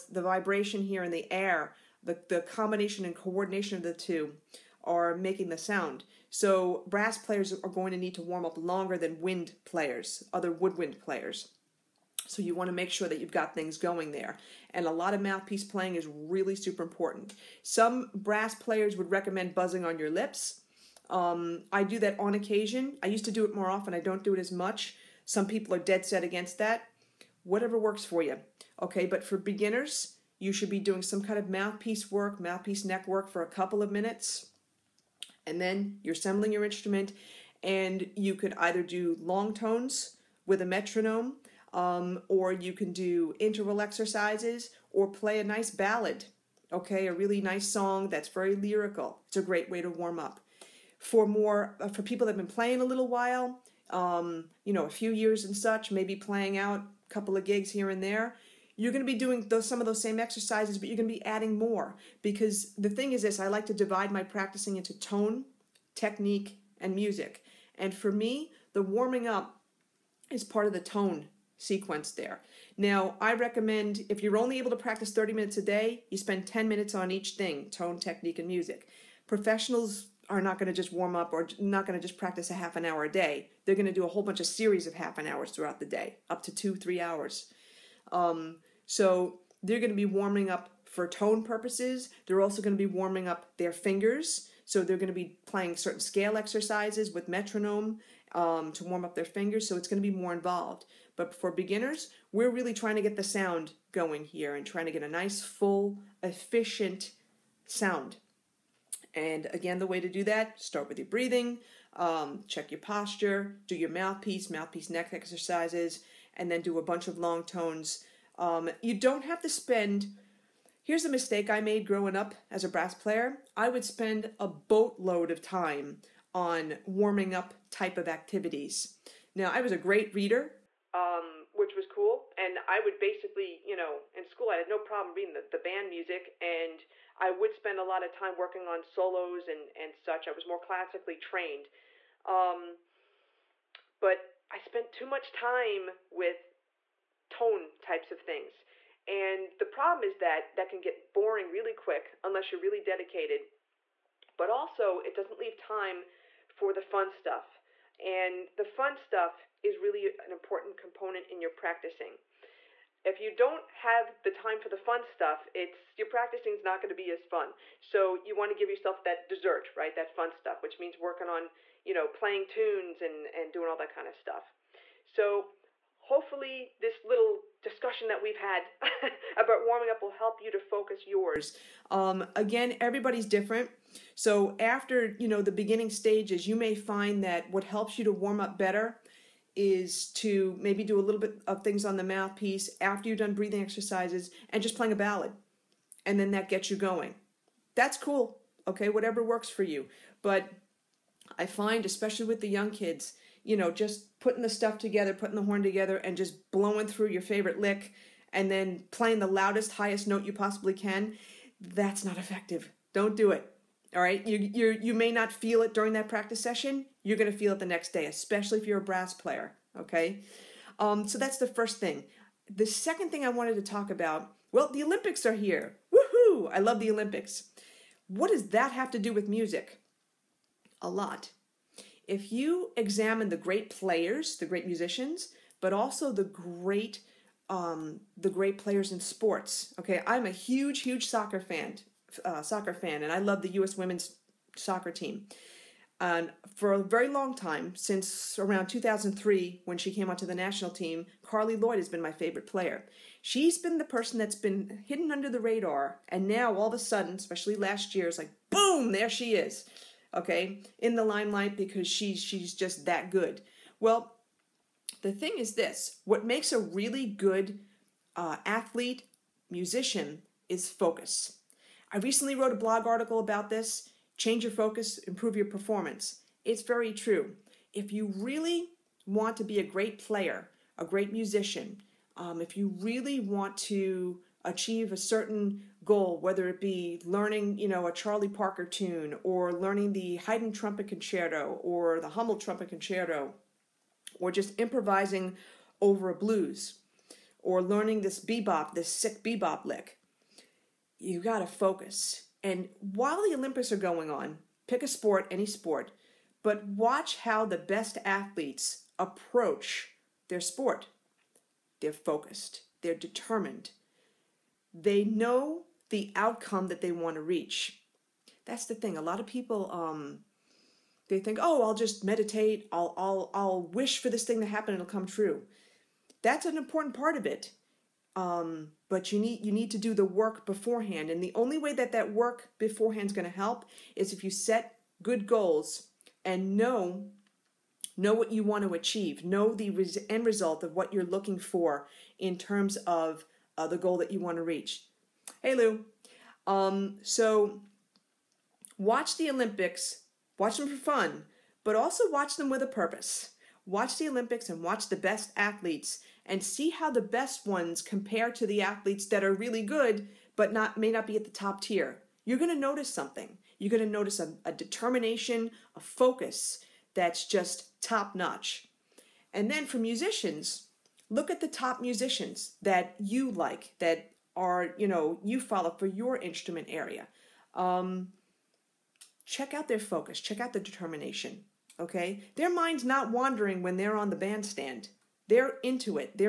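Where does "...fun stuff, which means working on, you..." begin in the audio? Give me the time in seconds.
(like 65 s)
170 s.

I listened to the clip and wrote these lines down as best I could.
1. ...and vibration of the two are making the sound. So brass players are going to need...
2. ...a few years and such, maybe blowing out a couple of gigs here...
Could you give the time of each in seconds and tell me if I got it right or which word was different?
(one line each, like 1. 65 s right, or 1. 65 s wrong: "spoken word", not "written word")
1. 3 s wrong: "coordination", not "vibration"
2. 54 s wrong: "playing", not "blowing".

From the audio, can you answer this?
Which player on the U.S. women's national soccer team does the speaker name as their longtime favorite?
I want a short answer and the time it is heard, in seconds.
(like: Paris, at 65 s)
Carli Lloyd, at 251 s.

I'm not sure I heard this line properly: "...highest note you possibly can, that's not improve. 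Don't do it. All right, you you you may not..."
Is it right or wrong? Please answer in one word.
wrong.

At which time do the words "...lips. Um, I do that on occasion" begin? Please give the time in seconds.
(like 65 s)
20 s.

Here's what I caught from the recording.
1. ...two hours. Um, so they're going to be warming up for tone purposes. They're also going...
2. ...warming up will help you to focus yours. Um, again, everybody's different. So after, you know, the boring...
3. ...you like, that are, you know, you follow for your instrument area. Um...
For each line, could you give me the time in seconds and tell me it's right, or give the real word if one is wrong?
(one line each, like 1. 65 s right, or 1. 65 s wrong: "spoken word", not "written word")
1. 86 s wrong: "three", not "two"
2. 179 s wrong: "beginning", not "boring"
3. 372 s right.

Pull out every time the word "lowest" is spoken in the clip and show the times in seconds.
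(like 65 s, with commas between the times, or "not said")
not said.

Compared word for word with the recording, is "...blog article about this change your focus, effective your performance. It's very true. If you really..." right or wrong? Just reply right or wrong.
wrong.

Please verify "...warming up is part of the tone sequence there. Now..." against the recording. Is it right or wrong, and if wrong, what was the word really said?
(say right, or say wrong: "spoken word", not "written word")
right.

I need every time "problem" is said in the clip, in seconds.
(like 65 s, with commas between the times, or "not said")
134 s, 149 s.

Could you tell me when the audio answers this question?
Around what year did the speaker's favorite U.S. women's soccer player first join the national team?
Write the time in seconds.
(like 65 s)
248 s.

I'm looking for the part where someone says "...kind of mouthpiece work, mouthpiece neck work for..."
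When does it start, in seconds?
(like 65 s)
31 s.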